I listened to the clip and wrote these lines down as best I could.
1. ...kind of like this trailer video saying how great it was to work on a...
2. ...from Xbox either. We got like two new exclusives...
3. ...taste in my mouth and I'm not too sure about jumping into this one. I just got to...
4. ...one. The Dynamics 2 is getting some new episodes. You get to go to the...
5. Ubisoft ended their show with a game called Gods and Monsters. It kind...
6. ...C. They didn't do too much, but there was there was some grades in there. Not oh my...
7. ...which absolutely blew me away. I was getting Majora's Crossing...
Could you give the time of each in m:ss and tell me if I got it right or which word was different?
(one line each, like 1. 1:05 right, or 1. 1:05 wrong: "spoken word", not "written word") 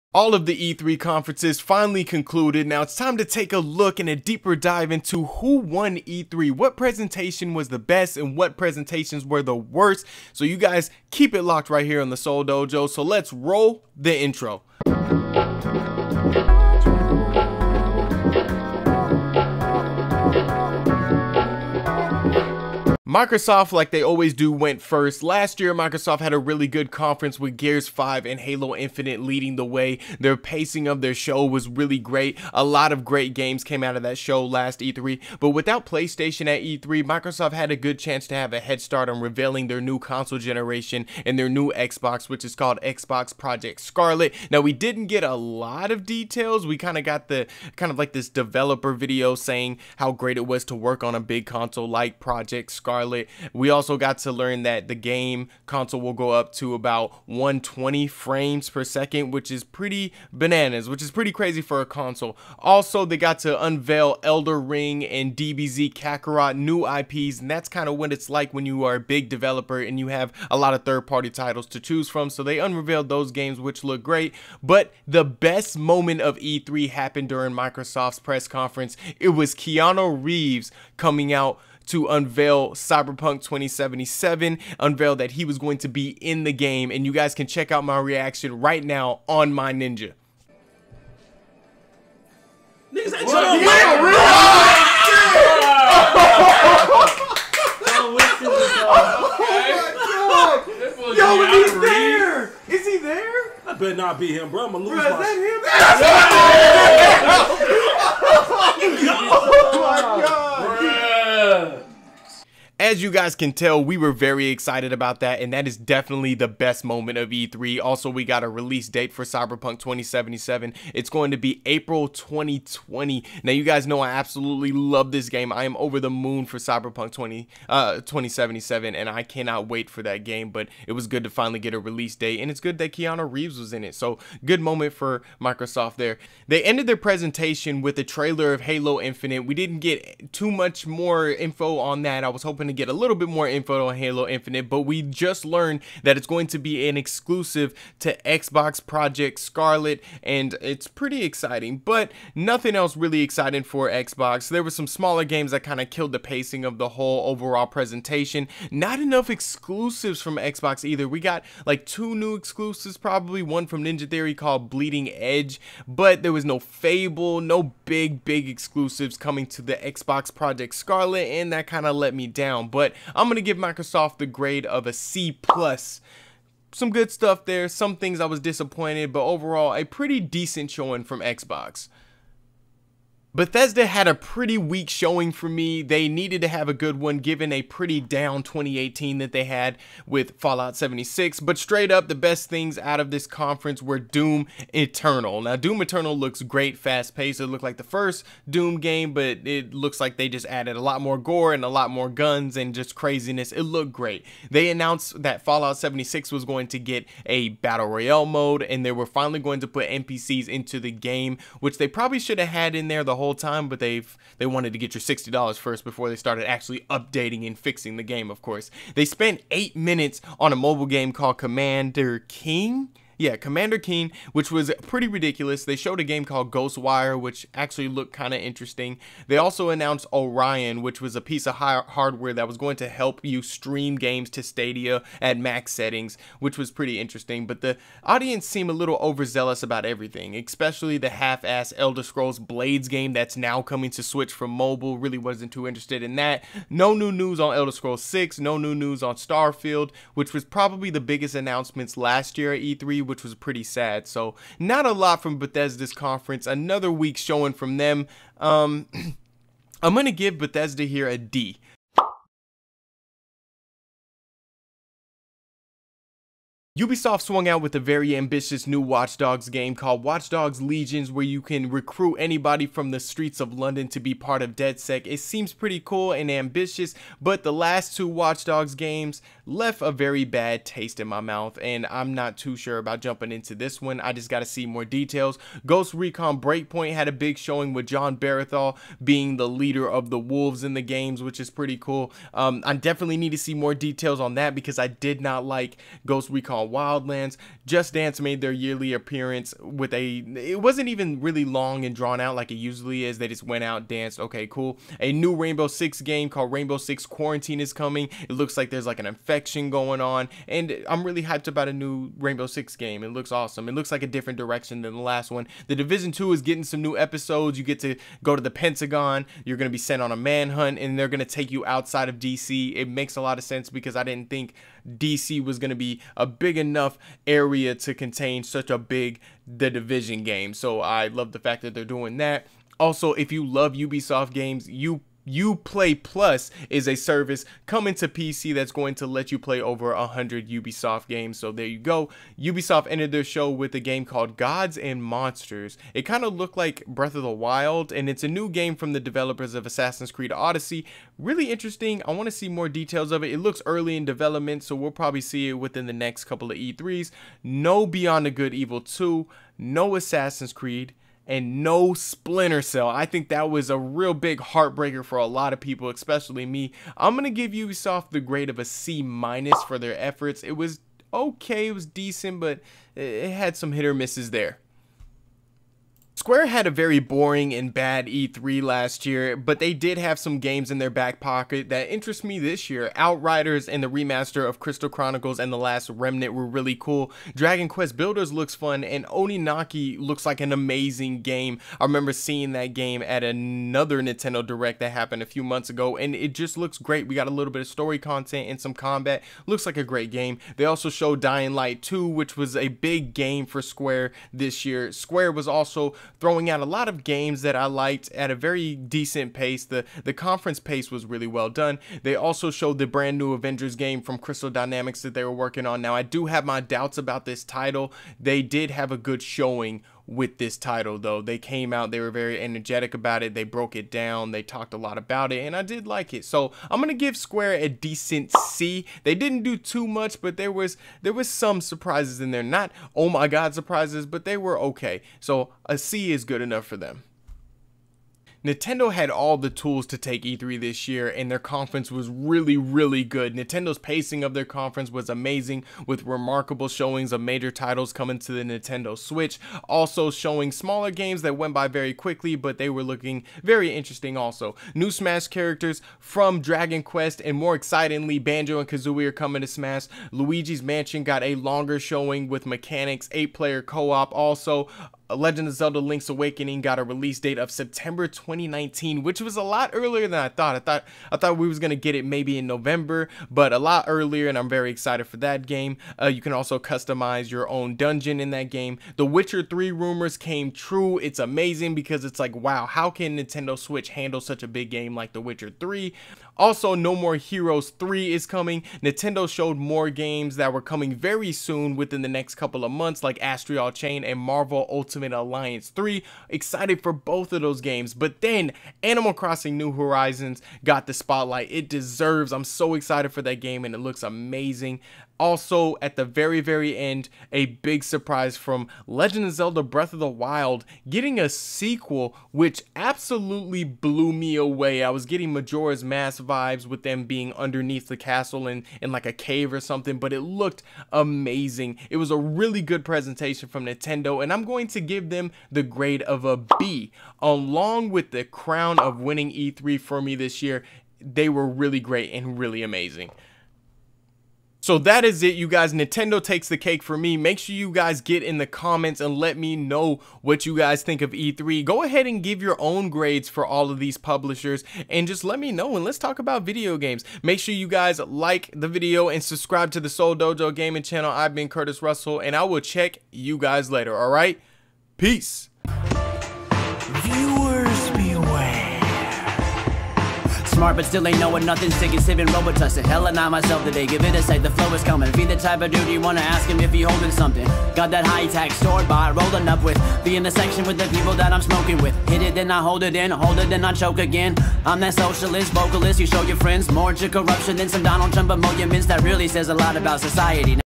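1. 0:47 wrong: "developer", not "trailer"
2. 2:40 right
3. 4:40 right
4. 5:15 wrong: "Division", not "Dynamics"
5. 5:42 right
6. 7:08 wrong: "surprises", not "grades"
7. 8:32 wrong: "Mask", not "Crossing".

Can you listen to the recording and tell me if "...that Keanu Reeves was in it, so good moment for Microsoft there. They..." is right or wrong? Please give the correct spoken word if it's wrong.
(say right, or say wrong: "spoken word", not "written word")
right.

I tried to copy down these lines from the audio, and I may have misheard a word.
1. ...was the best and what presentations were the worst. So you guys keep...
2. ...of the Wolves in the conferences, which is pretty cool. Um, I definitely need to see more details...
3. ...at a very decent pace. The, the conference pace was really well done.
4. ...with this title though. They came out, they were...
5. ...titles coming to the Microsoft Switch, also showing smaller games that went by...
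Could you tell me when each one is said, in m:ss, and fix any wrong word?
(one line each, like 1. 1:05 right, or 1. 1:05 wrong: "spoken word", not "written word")
1. 0:07 right
2. 4:49 wrong: "games", not "conferences"
3. 6:48 right
4. 7:00 right
5. 7:27 wrong: "Nintendo", not "Microsoft".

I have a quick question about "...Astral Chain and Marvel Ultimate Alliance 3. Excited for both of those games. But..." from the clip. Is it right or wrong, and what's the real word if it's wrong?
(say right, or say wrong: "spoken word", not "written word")
right.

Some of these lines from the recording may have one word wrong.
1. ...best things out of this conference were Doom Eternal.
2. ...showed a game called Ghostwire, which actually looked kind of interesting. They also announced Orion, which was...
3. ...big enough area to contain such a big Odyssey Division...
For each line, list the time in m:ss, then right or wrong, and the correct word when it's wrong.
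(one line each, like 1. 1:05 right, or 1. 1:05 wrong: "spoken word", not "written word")
1. 3:12 right
2. 3:45 right
3. 5:26 wrong: "The", not "Odyssey".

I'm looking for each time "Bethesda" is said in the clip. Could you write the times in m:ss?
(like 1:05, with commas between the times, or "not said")
3:03, 4:15, 4:20.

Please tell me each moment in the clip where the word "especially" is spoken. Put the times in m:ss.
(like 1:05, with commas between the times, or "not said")
4:00, 6:05.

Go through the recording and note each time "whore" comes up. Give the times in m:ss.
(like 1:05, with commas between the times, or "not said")
not said.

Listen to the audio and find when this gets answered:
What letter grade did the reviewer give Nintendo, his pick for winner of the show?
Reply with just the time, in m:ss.
8:46.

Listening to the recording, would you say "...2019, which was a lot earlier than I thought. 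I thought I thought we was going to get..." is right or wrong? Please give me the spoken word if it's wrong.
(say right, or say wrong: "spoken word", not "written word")
right.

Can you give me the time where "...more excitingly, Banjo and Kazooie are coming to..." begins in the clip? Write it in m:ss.
7:37.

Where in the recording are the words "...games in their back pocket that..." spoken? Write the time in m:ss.
6:20.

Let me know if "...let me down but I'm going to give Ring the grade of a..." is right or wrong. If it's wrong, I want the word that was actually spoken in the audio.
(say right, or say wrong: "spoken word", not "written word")
wrong: "Microsoft", not "Ring".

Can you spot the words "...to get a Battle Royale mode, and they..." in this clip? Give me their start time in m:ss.
3:26.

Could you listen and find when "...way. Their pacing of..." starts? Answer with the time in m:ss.
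0:29.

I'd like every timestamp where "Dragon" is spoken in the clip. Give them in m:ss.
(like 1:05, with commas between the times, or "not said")
6:27, 7:36.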